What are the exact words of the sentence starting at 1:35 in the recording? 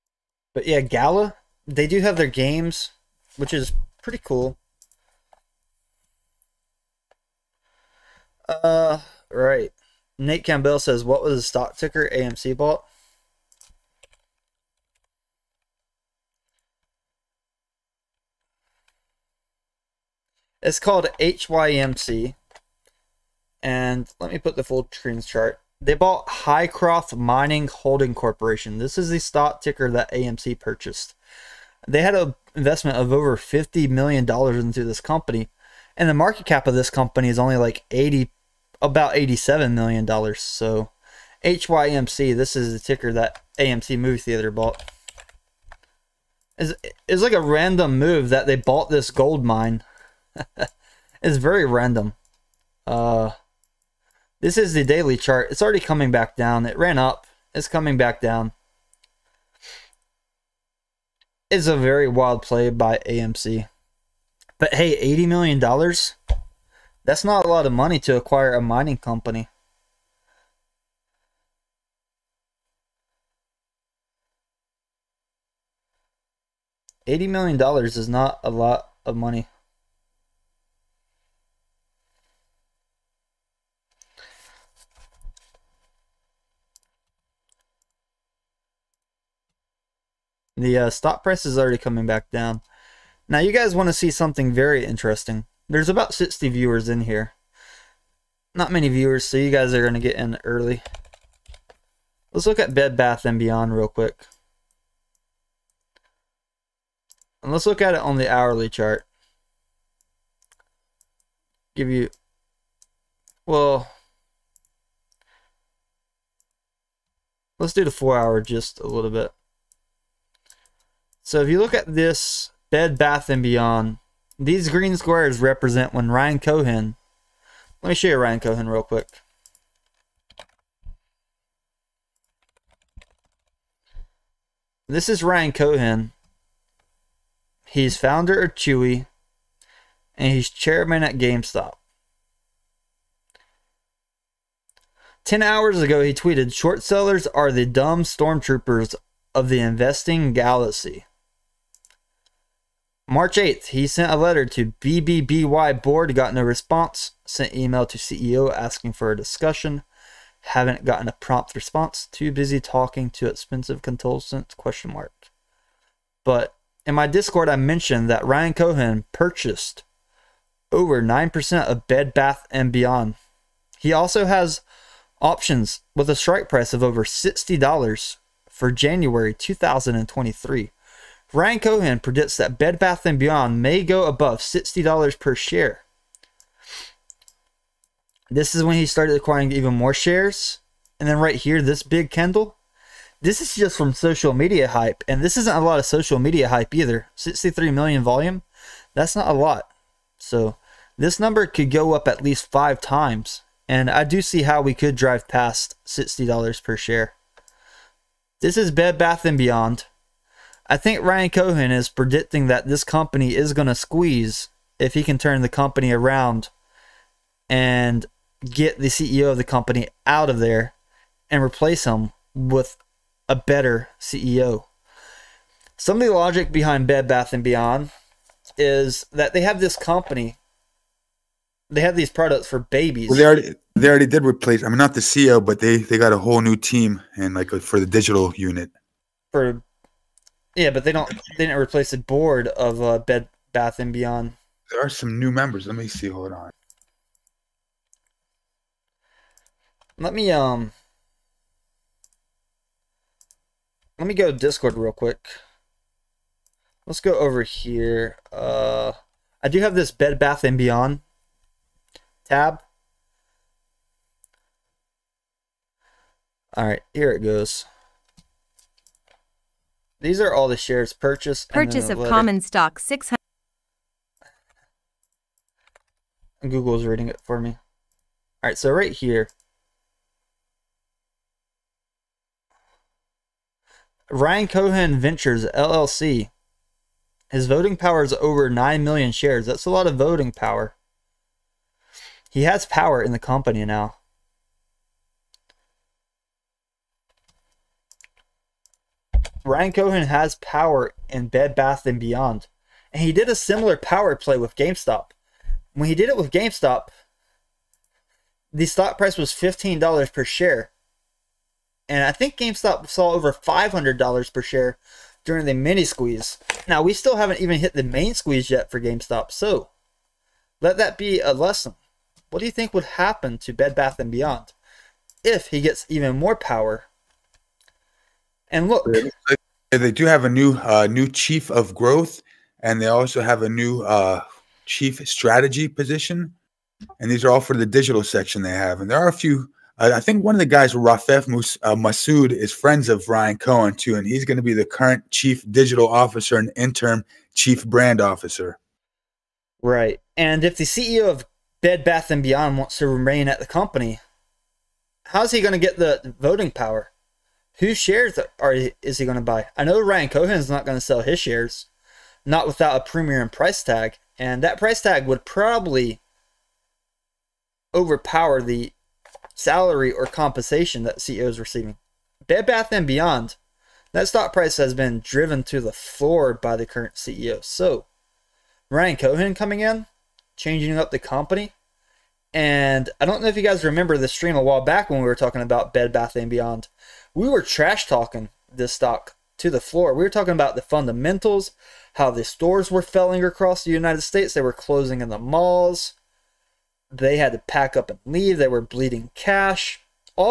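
There's about 60 viewers in here.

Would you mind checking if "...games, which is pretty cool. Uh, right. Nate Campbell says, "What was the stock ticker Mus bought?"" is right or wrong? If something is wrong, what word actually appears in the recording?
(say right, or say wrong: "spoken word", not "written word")
wrong: "AMC", not "Mus".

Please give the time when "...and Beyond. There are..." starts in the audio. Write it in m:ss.
4:03.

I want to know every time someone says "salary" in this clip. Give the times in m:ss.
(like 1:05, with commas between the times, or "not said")
6:09.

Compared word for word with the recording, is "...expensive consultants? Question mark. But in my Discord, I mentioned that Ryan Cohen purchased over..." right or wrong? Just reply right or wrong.
right.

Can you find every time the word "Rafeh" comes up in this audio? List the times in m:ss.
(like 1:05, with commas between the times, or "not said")
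5:40.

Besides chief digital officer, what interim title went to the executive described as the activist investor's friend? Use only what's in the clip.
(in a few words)
Interim chief brand officer.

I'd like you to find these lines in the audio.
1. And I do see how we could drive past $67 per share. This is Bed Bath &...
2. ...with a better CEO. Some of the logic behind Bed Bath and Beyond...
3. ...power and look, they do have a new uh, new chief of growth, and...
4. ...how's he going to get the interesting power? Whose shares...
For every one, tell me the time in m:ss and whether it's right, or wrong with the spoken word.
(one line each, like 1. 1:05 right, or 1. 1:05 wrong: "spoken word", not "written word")
1. 3:23 wrong: "60", not "67"
2. 3:42 right
3. 5:26 right
4. 5:55 wrong: "voting", not "interesting".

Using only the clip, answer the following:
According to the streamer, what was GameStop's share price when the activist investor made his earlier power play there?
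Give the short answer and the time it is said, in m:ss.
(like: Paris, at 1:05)
$15, at 5:09.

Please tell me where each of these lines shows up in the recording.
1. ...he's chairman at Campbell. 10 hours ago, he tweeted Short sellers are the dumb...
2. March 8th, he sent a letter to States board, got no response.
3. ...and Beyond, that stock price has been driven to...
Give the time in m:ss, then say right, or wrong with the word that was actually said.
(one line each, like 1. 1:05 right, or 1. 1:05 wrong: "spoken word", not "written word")
1. 2:20 wrong: "GameStop", not "Campbell"
2. 2:33 wrong: "BBBY", not "States"
3. 6:12 right.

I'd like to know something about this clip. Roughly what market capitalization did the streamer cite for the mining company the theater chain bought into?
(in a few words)
$87 million.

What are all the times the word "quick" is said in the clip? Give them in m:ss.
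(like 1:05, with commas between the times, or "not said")
1:43, 2:08, 4:14.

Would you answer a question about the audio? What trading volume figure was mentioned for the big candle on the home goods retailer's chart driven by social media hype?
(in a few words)
63 million.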